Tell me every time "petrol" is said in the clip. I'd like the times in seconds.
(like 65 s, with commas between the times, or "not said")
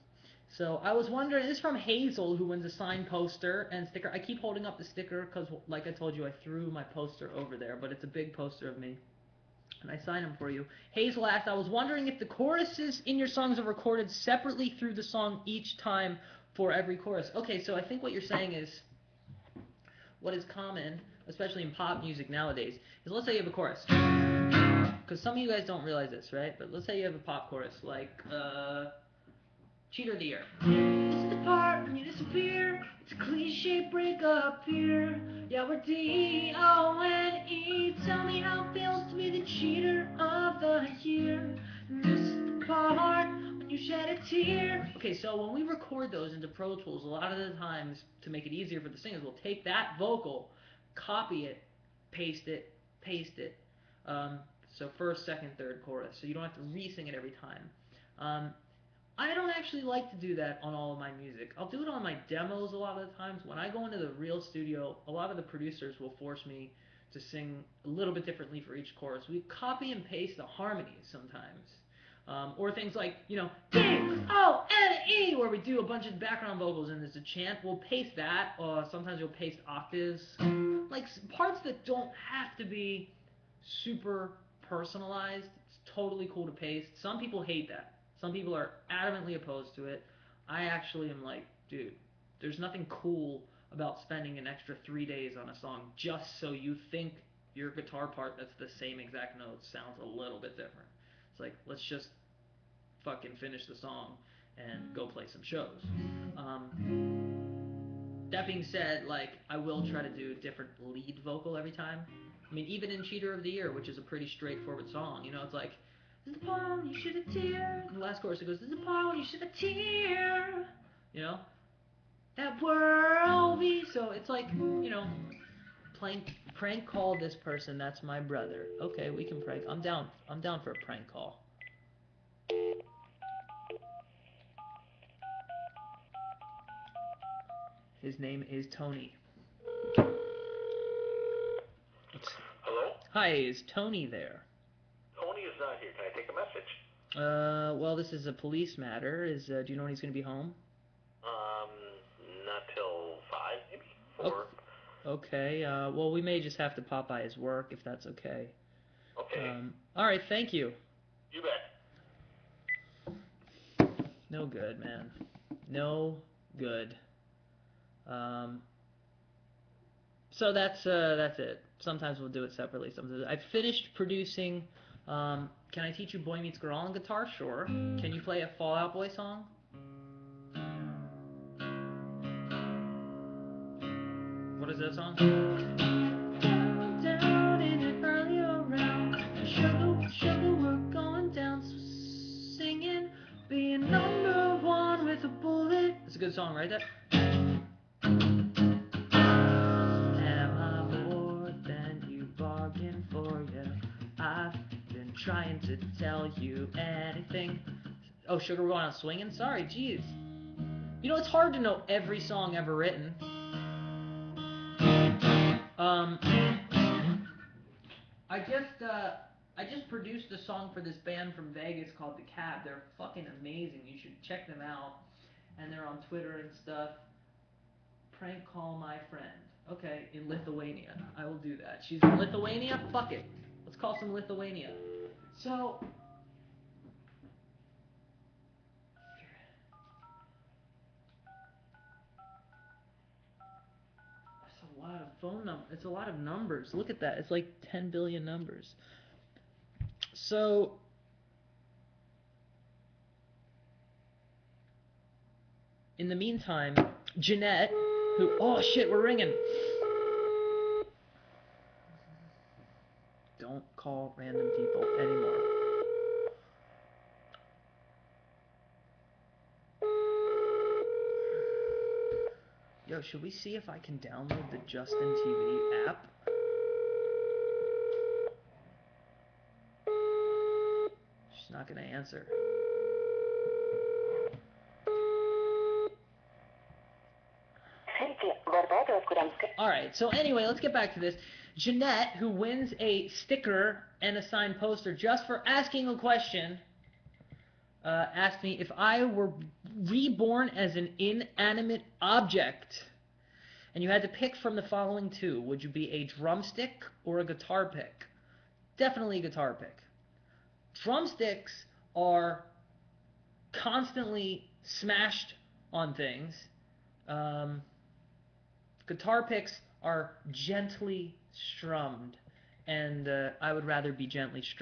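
not said.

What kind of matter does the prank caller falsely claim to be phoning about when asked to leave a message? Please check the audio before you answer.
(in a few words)
a police matter.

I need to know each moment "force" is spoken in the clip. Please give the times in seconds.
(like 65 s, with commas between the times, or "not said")
66 s.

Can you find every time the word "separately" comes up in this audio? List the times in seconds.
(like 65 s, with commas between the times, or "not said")
14 s, 172 s.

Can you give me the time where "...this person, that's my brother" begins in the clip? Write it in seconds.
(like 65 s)
127 s.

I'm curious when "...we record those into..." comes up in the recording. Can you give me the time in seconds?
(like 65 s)
45 s.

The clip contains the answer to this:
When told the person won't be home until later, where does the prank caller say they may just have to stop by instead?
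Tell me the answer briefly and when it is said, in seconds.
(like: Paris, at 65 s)
his work, at 157 s.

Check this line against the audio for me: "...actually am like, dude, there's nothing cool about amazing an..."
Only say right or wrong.
wrong.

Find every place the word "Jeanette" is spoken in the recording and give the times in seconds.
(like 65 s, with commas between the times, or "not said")
257 s, 291 s.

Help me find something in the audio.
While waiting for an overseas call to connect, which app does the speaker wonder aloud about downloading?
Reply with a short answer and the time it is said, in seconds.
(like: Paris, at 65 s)
Justin TV, at 274 s.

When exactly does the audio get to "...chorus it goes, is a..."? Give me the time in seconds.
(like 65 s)
118 s.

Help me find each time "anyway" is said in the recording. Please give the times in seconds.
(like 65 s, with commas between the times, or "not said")
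290 s.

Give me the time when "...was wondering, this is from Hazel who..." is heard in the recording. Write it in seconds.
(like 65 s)
0 s.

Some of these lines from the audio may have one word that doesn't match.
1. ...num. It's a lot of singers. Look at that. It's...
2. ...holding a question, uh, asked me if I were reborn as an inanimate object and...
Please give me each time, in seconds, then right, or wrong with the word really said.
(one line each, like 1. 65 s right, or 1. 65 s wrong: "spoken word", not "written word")
1. 245 s wrong: "numbers", not "singers"
2. 295 s wrong: "asking", not "holding".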